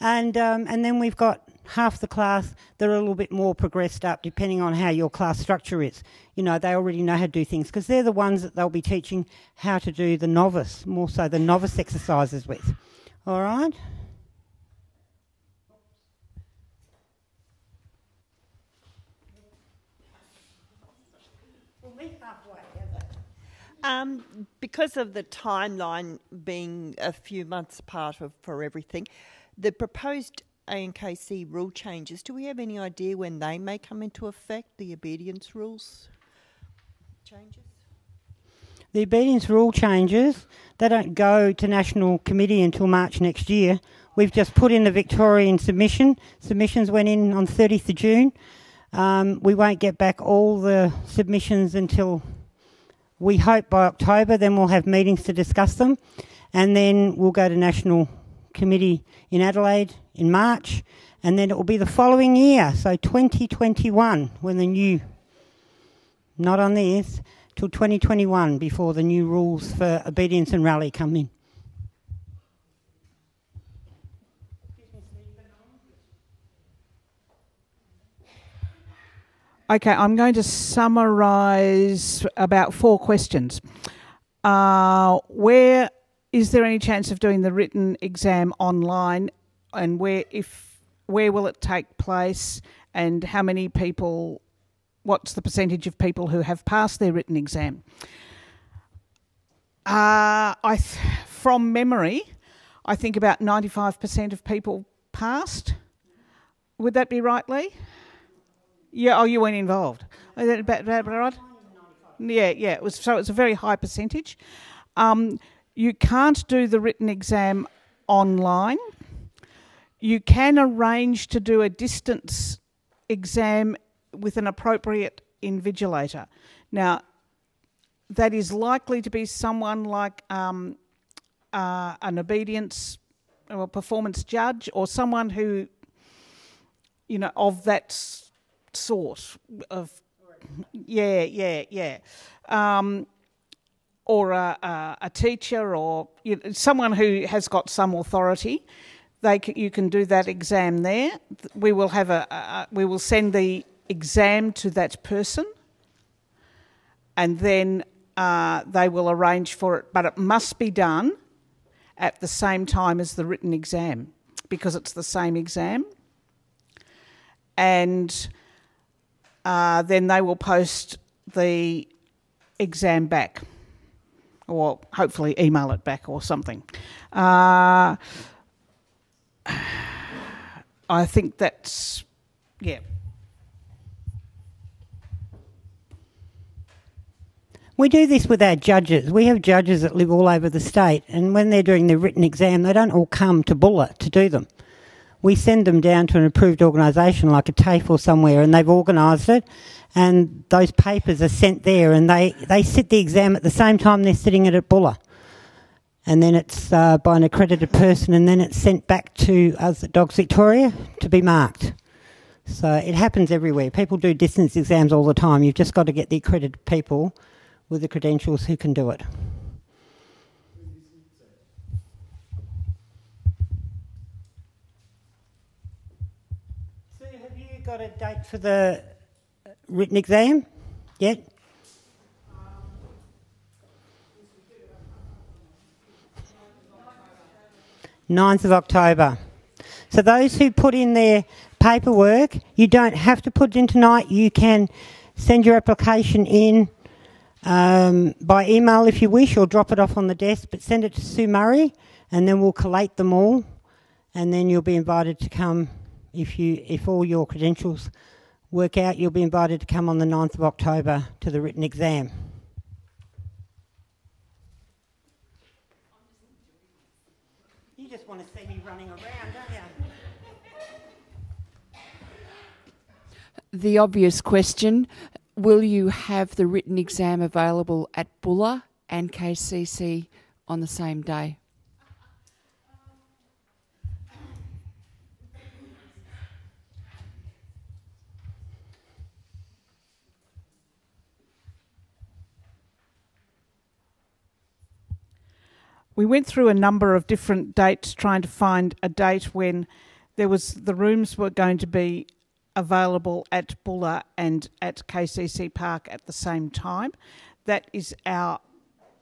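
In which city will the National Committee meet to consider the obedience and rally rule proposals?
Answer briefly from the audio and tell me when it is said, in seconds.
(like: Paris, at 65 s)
Adelaide, at 59 s.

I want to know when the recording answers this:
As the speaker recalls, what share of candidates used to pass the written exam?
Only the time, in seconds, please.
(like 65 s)
103 s.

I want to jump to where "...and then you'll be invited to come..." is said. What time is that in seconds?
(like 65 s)
254 s.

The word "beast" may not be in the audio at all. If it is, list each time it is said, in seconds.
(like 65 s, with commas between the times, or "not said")
not said.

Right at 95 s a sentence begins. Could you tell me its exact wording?
What's the percentage of people who have passed their written exam?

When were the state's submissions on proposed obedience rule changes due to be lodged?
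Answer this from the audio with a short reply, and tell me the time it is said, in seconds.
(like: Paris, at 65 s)
30th of June, at 47 s.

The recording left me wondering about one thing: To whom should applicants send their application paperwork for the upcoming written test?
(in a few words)
Sue Murray.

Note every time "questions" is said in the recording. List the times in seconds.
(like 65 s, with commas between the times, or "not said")
82 s, 274 s.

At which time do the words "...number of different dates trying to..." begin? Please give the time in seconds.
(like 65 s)
296 s.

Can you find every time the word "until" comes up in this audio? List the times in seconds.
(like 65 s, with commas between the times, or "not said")
42 s, 51 s.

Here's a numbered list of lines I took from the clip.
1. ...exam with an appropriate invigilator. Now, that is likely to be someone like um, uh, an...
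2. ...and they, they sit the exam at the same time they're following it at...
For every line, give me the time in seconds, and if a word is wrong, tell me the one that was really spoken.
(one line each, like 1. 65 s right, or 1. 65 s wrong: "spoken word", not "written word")
1. 123 s right
2. 201 s wrong: "sitting", not "following".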